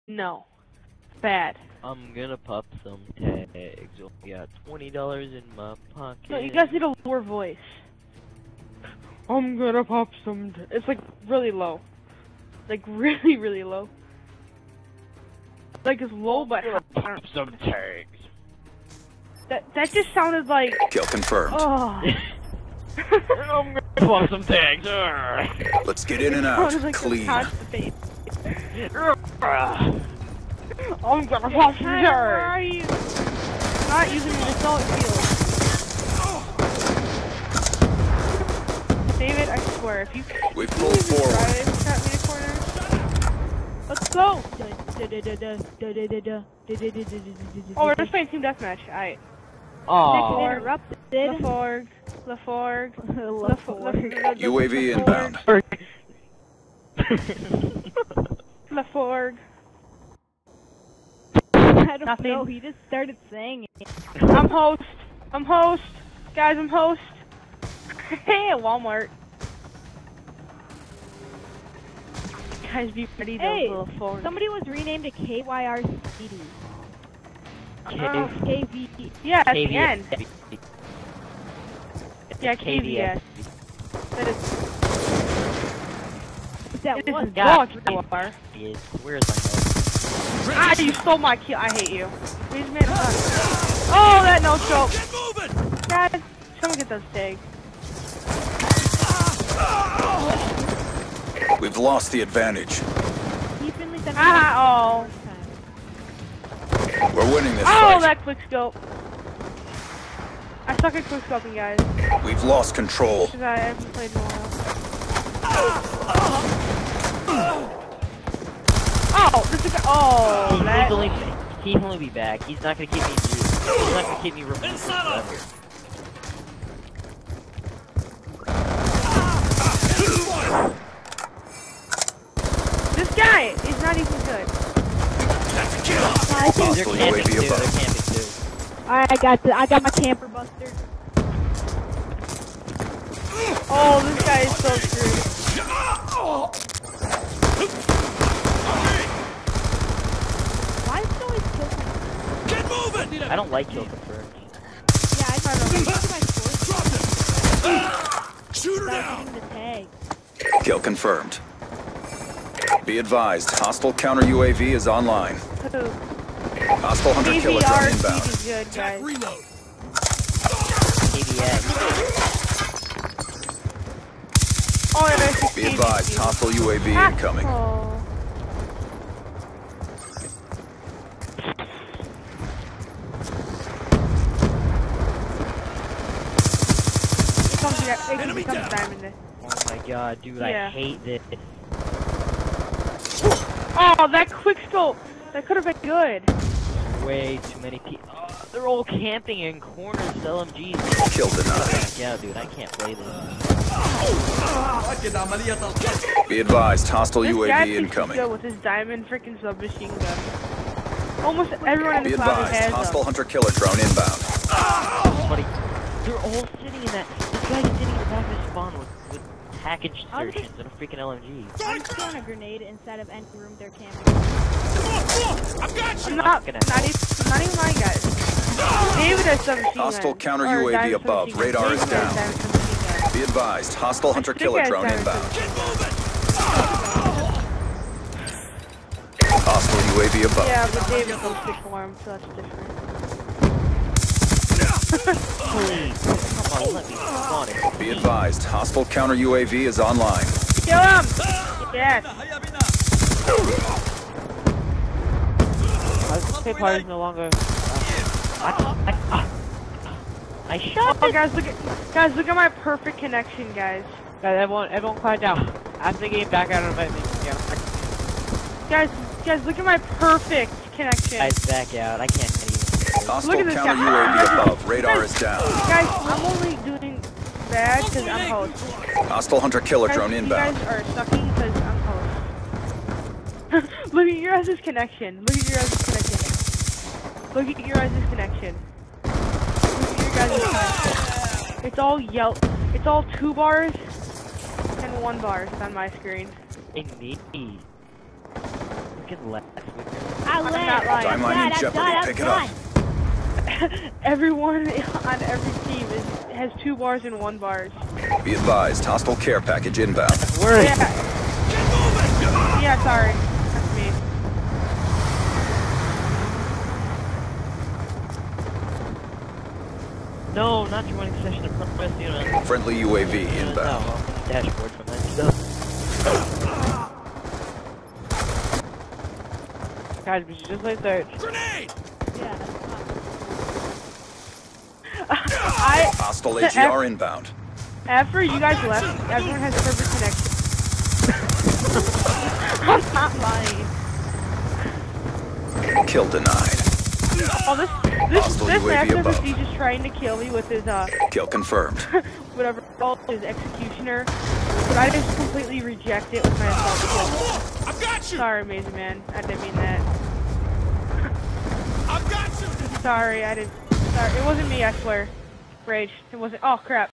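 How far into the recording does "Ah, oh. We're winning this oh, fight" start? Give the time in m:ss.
1:44.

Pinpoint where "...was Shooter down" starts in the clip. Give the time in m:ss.
2:37.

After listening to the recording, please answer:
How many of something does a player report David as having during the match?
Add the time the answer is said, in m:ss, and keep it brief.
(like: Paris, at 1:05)
17, at 3:49.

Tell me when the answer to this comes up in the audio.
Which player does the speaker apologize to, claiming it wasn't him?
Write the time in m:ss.
5:58.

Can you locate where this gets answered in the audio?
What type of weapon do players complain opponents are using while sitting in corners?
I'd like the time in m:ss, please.
3:20.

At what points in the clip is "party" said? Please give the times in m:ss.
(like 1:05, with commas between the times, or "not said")
4:16.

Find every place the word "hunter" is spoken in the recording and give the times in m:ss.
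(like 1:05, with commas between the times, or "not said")
2:47, 3:33, 3:54, 4:39.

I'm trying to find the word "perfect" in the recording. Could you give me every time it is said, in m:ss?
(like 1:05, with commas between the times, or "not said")
4:22, 4:29, 5:39.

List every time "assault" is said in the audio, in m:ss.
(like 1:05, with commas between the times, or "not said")
0:34, 5:56.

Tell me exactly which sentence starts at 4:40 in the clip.
You guys are sucking because I'm host.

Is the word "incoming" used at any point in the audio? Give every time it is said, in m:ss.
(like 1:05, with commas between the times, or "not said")
2:57, 3:27.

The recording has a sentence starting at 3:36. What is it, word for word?
they're all sitting in that guys didn't even have to spawn with, with package surgeons and a freaking LMG.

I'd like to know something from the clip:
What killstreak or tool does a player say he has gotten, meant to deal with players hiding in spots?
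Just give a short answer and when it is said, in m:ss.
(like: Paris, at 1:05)
Camper buster, at 2:19.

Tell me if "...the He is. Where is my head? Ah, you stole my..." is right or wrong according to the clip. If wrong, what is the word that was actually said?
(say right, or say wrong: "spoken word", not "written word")
right.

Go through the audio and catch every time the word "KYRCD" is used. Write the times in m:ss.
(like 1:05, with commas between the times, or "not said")
1:15.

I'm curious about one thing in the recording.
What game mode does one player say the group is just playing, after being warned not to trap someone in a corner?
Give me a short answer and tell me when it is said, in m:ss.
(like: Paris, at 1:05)
Team deathmatch, at 0:48.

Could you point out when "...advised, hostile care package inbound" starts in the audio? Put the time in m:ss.
5:08.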